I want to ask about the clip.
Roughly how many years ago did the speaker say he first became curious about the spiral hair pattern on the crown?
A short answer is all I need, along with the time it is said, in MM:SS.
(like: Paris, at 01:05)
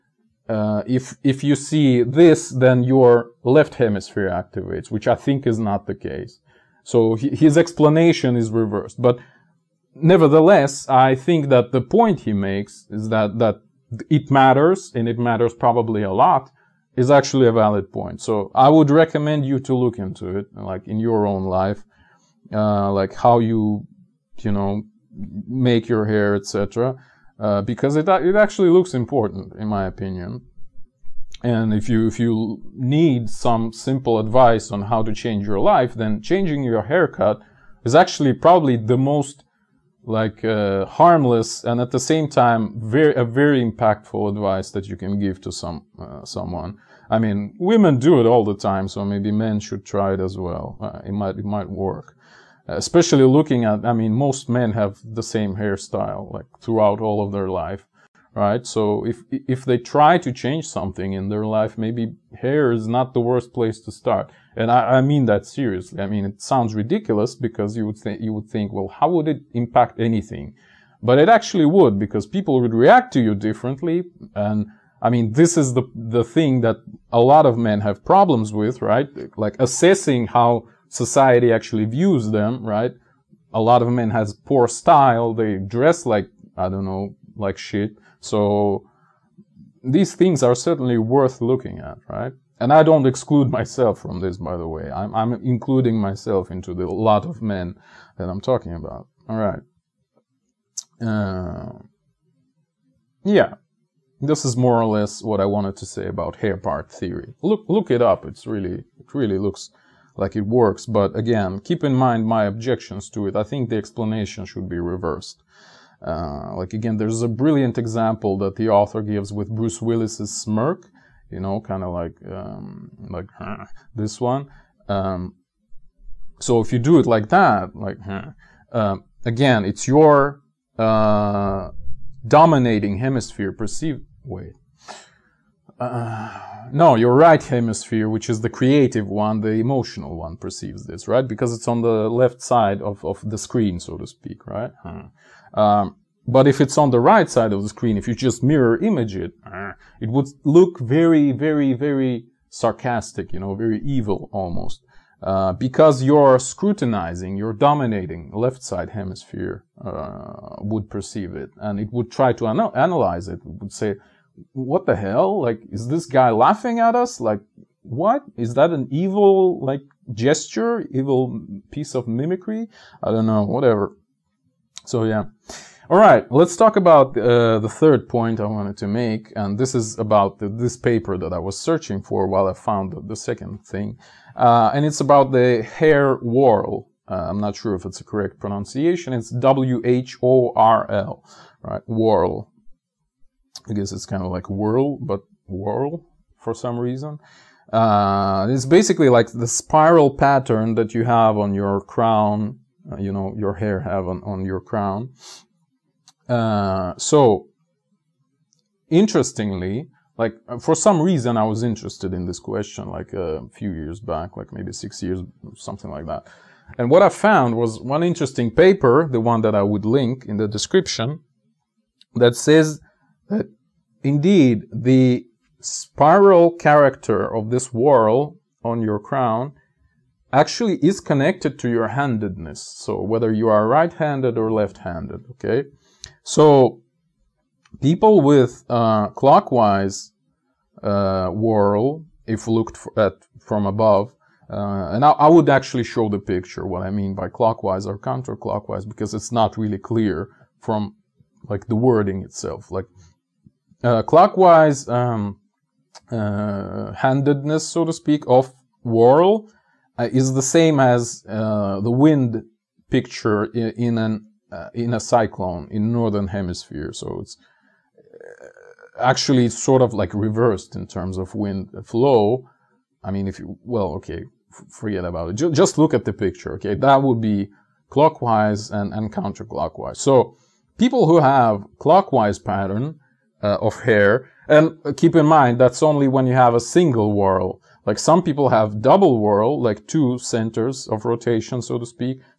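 6, at 03:34.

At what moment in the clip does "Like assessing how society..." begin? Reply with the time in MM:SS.
01:19.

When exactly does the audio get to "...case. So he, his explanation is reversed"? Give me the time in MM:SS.
00:05.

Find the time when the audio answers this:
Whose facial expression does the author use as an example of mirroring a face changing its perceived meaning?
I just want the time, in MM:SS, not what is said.
01:59.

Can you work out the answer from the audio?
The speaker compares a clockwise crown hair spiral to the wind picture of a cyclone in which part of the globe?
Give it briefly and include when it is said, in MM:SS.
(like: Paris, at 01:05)
northern hemisphere, at 04:25.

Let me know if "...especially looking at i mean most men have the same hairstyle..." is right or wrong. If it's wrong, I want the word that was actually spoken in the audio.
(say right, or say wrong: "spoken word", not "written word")
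right.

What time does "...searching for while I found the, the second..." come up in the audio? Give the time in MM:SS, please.
03:01.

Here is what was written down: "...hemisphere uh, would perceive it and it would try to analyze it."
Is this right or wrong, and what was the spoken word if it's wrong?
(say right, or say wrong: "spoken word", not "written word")
right.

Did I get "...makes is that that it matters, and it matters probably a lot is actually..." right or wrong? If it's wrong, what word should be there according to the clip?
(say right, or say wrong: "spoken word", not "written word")
right.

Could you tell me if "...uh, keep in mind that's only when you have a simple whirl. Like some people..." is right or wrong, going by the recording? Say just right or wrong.
wrong.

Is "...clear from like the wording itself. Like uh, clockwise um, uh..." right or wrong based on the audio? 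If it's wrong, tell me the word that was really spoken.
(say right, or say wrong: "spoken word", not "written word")
right.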